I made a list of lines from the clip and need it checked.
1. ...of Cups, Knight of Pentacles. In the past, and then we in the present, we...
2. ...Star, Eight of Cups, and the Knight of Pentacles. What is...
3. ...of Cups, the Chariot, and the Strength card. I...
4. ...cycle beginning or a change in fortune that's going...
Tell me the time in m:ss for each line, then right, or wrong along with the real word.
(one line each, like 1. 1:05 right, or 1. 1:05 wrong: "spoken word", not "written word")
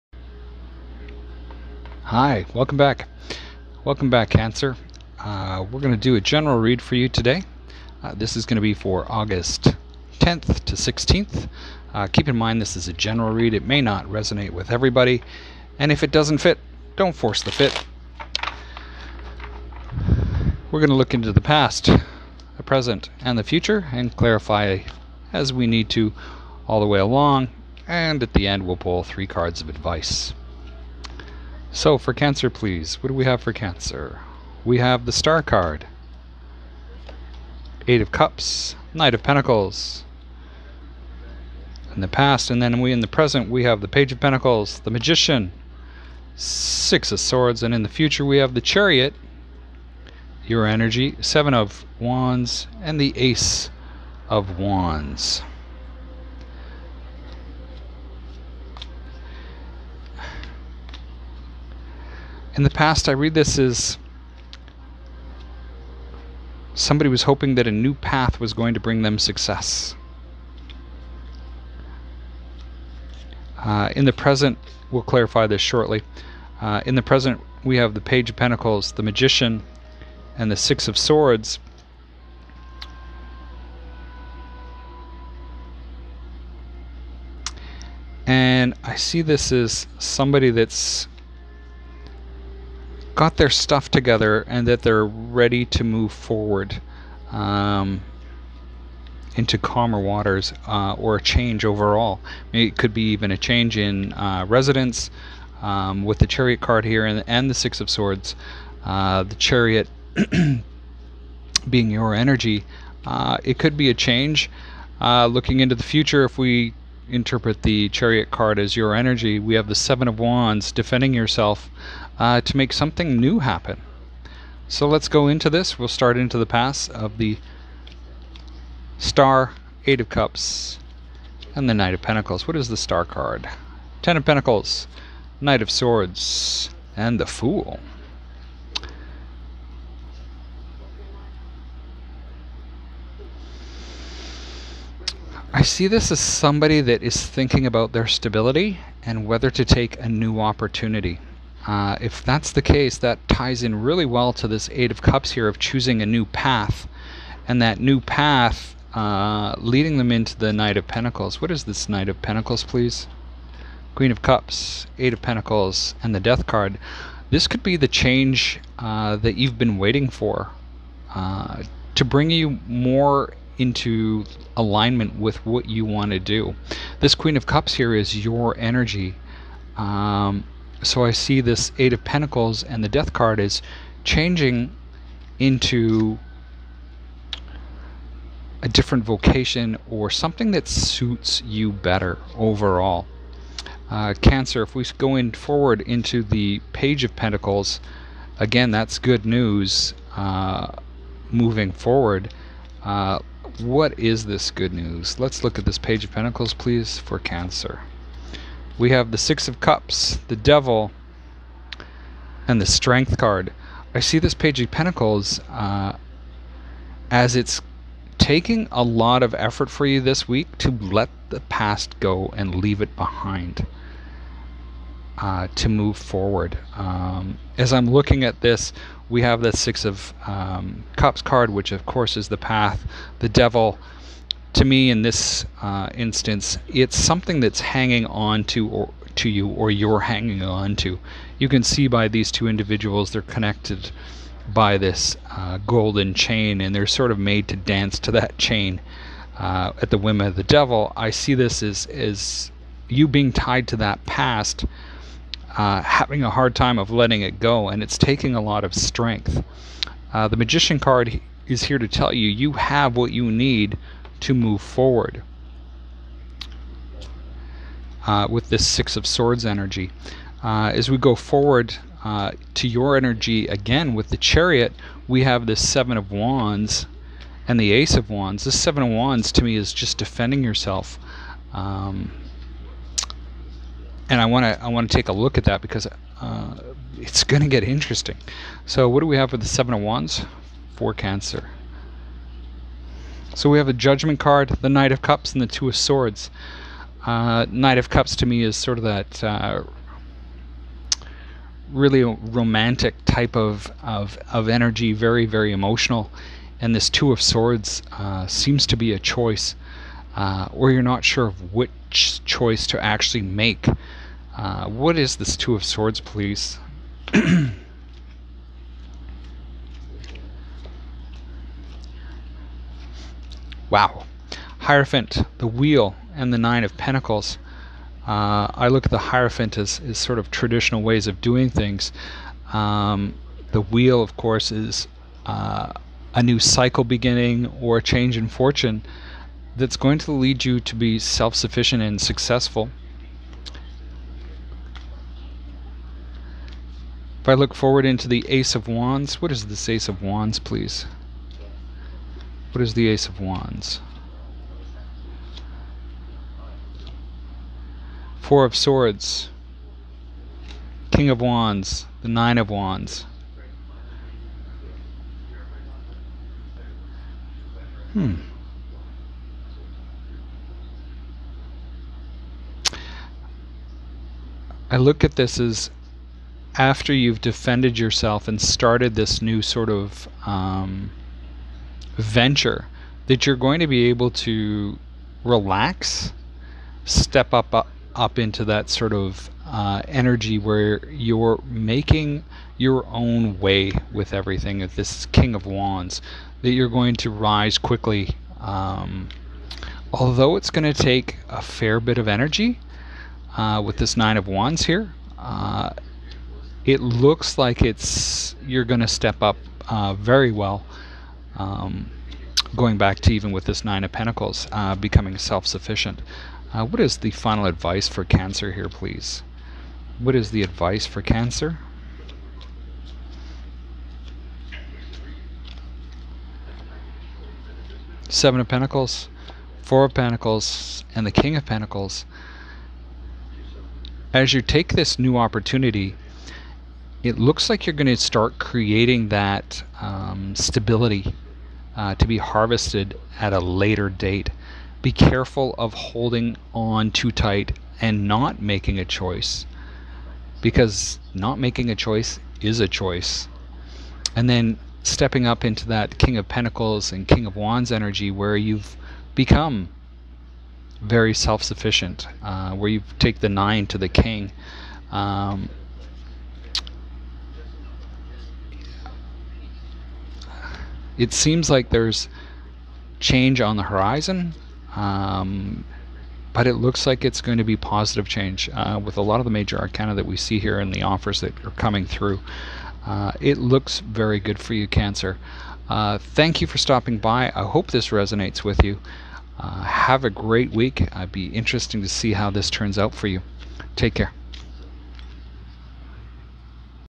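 1. 0:38 right
2. 2:08 right
3. 3:29 wrong: "Devil", not "Chariot"
4. 5:36 right.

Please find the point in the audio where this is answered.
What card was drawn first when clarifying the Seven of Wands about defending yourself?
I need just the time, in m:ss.
4:53.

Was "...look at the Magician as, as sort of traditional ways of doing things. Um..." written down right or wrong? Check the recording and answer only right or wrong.
wrong.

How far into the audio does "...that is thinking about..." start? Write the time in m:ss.
2:26.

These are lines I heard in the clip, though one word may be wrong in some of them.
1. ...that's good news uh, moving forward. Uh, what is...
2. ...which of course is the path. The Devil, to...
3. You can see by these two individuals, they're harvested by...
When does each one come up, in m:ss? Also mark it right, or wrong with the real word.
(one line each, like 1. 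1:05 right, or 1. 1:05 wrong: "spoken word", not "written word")
1. 3:18 right
2. 3:51 right
3. 4:01 wrong: "connected", not "harvested".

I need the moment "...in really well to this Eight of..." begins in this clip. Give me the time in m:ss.
2:33.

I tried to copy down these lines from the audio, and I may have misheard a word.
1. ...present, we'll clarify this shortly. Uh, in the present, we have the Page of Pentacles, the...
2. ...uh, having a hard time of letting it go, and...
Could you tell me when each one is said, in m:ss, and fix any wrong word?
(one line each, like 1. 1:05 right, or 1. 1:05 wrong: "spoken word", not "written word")
1. 1:14 right
2. 4:15 right.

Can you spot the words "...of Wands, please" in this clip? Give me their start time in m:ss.
5:49.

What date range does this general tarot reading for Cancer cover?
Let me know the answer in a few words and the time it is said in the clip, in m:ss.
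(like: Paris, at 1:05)
August 10th to 16th, at 0:09.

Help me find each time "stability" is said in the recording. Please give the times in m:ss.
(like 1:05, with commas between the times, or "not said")
2:28, 7:20.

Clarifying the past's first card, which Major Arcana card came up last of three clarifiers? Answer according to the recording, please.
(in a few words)
The Fool.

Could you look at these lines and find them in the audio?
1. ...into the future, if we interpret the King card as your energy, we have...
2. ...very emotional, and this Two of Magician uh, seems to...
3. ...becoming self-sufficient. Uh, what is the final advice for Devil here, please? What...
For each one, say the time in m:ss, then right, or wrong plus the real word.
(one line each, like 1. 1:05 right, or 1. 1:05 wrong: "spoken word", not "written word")
1. 1:55 wrong: "Chariot", not "King"
2. 5:05 wrong: "Swords", not "Magician"
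3. 6:54 wrong: "Cancer", not "Devil".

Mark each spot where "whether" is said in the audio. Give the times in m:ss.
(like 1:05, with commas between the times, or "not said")
2:29.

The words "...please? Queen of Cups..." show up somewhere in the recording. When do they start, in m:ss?
2:42.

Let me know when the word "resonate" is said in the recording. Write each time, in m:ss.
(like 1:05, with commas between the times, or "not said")
0:14, 8:07.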